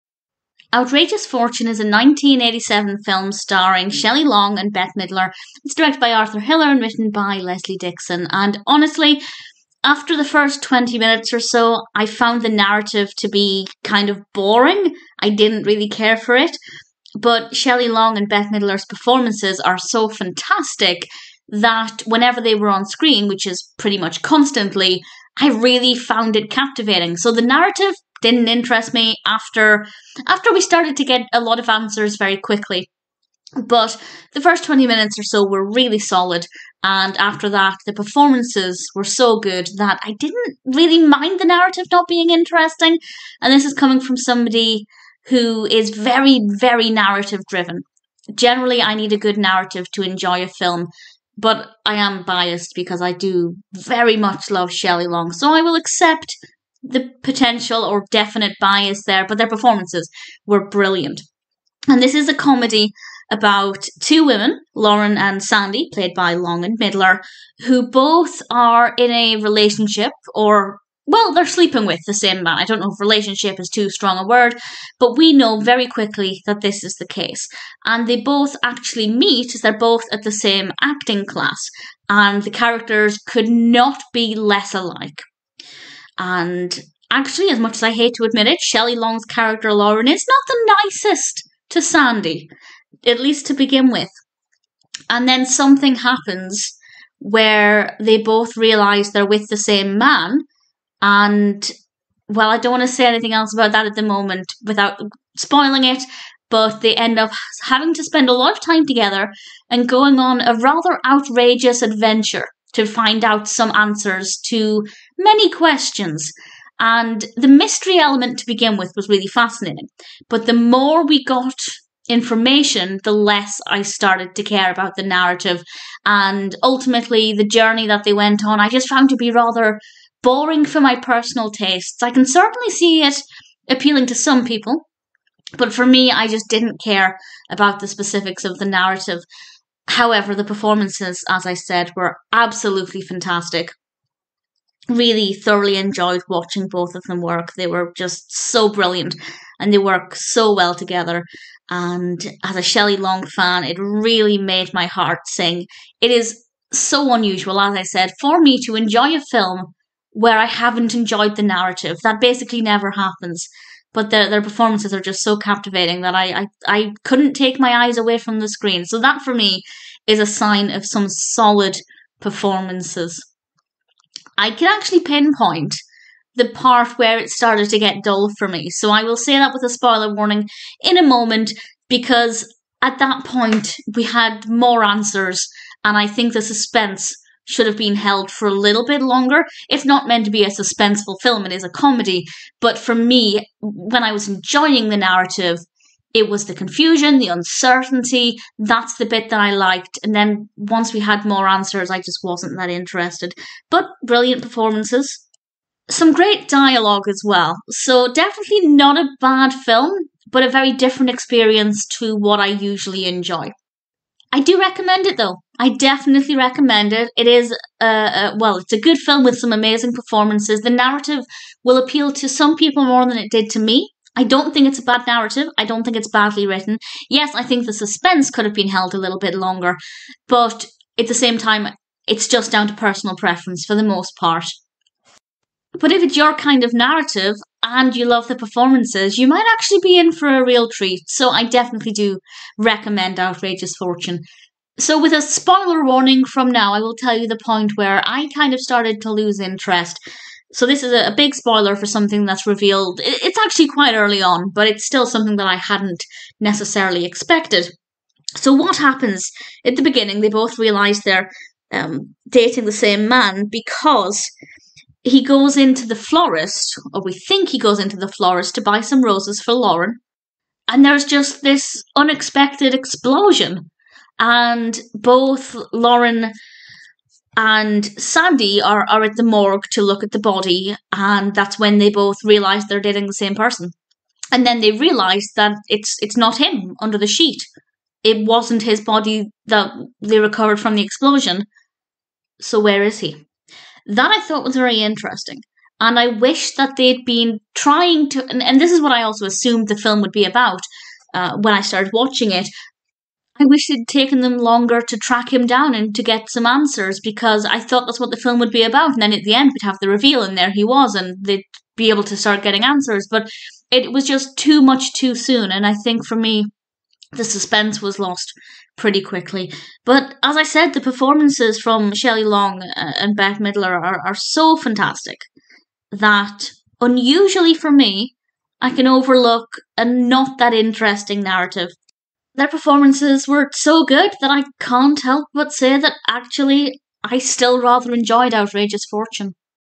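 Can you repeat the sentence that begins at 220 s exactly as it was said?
The narrative will appeal to some people more than it did to me.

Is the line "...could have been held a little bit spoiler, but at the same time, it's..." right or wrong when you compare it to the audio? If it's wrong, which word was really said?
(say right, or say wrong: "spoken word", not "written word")
wrong: "longer", not "spoiler".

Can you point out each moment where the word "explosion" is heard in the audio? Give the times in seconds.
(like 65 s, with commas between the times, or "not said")
272 s, 290 s.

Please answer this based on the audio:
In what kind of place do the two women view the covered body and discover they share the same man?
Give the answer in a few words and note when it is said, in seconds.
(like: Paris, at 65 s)
the morgue, at 279 s.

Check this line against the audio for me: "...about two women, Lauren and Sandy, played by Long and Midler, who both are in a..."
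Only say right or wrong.
right.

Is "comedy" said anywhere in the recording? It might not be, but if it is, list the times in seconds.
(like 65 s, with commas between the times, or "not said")
62 s, 191 s.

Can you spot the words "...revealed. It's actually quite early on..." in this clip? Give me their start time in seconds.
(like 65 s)
252 s.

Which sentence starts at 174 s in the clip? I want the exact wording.
I can actually pinpoint the part where it started to get dull for me.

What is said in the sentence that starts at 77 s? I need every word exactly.
And they both actually meet, as they're both at the same acting class, and the characters could not be less alike.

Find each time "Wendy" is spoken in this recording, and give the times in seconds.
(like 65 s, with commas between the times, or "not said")
not said.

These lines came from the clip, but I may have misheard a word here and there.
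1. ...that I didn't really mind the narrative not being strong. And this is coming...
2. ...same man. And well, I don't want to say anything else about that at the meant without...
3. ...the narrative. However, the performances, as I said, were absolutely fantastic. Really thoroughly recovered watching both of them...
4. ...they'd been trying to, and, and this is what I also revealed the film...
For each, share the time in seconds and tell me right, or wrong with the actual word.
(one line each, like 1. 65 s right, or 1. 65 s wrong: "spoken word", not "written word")
1. 39 s wrong: "interesting", not "strong"
2. 99 s wrong: "moment", not "meant"
3. 138 s wrong: "enjoyed", not "recovered"
4. 296 s wrong: "assumed", not "revealed".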